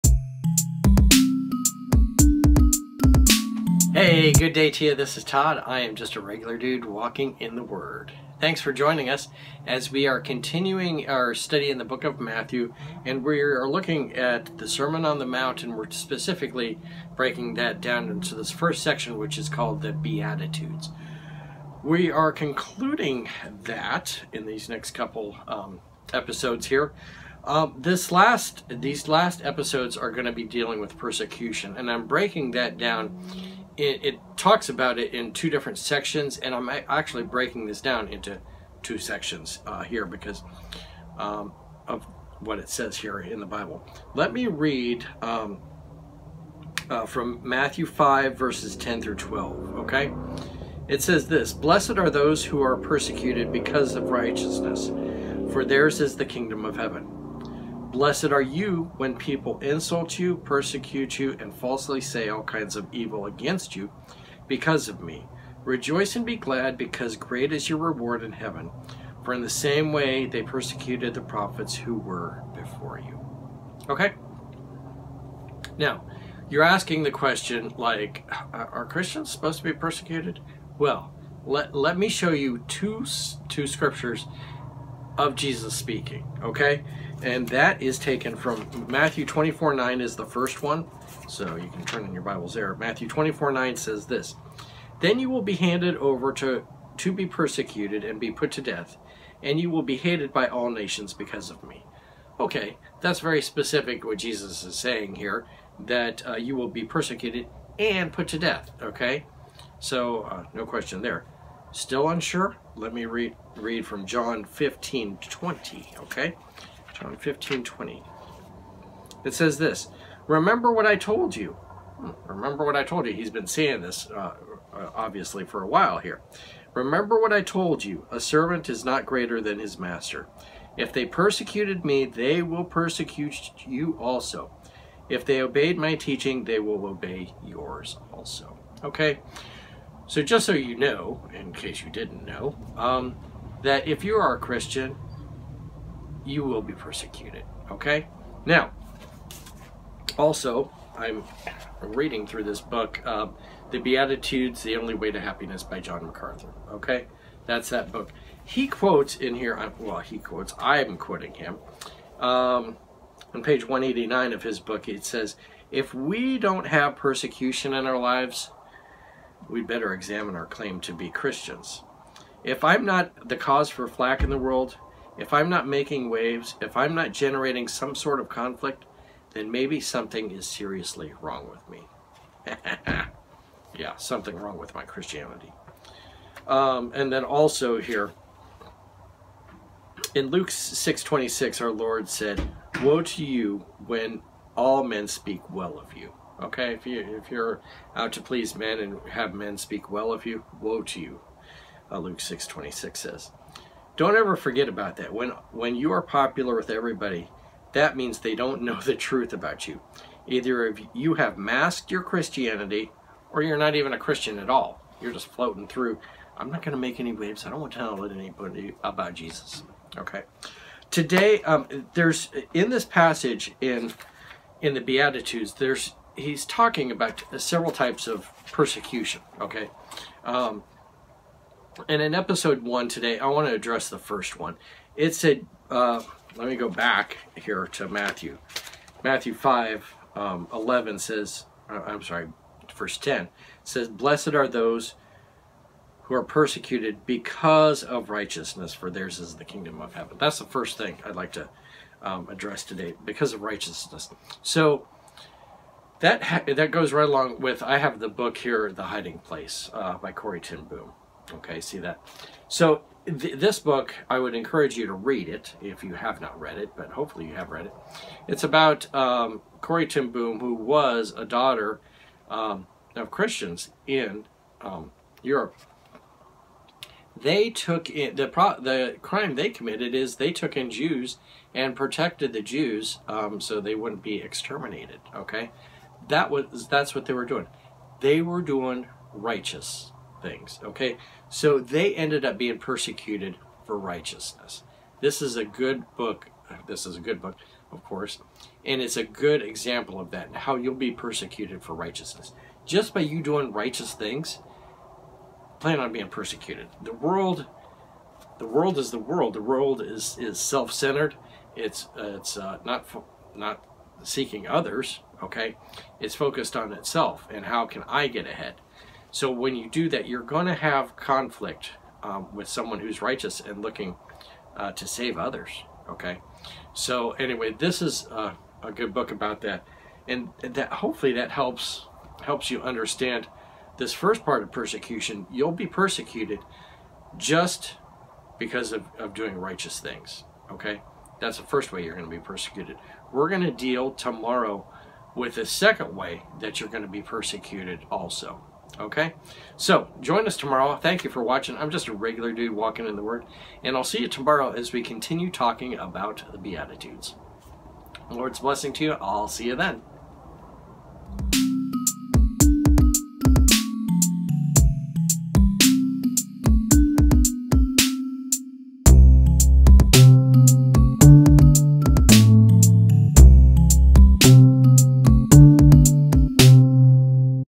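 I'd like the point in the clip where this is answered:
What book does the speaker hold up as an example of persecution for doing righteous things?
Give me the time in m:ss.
4:18.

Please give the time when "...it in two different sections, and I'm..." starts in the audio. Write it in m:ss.
0:34.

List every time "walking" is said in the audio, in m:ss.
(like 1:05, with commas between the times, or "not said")
0:06, 5:52.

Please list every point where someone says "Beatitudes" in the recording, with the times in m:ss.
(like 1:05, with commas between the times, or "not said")
0:19, 2:33, 3:44, 5:56.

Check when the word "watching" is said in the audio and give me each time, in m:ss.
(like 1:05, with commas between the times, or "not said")
5:51.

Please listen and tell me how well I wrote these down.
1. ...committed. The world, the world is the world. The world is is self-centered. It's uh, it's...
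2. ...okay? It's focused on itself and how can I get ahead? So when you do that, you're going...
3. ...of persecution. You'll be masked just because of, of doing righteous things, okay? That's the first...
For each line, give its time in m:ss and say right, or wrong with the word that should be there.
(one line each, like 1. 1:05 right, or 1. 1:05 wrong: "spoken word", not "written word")
1. 5:06 wrong: "persecuted", not "committed"
2. 5:15 right
3. 5:34 wrong: "persecuted", not "masked".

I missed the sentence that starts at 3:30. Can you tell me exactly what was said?
Either if you have masked your Christianity or you're not even a Christian at all.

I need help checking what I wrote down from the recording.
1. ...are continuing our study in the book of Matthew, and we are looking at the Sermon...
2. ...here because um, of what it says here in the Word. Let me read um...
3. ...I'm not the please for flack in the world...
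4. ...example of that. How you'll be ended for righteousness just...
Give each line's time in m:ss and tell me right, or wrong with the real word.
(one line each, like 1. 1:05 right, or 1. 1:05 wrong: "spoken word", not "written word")
1. 0:10 right
2. 0:39 wrong: "Bible", not "Word"
3. 2:52 wrong: "cause", not "please"
4. 4:59 wrong: "persecuted", not "ended".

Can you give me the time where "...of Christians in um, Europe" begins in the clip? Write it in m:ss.
4:32.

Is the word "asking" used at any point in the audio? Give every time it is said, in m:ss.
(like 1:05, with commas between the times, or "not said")
1:16.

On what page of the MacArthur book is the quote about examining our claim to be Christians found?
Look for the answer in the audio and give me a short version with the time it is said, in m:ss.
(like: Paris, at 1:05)
189, at 2:43.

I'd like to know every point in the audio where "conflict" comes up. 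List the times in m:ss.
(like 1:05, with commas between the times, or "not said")
2:58, 5:20.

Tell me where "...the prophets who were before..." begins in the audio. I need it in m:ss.
1:11.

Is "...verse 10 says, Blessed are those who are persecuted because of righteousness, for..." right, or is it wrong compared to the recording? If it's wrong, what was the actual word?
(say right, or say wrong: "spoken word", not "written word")
right.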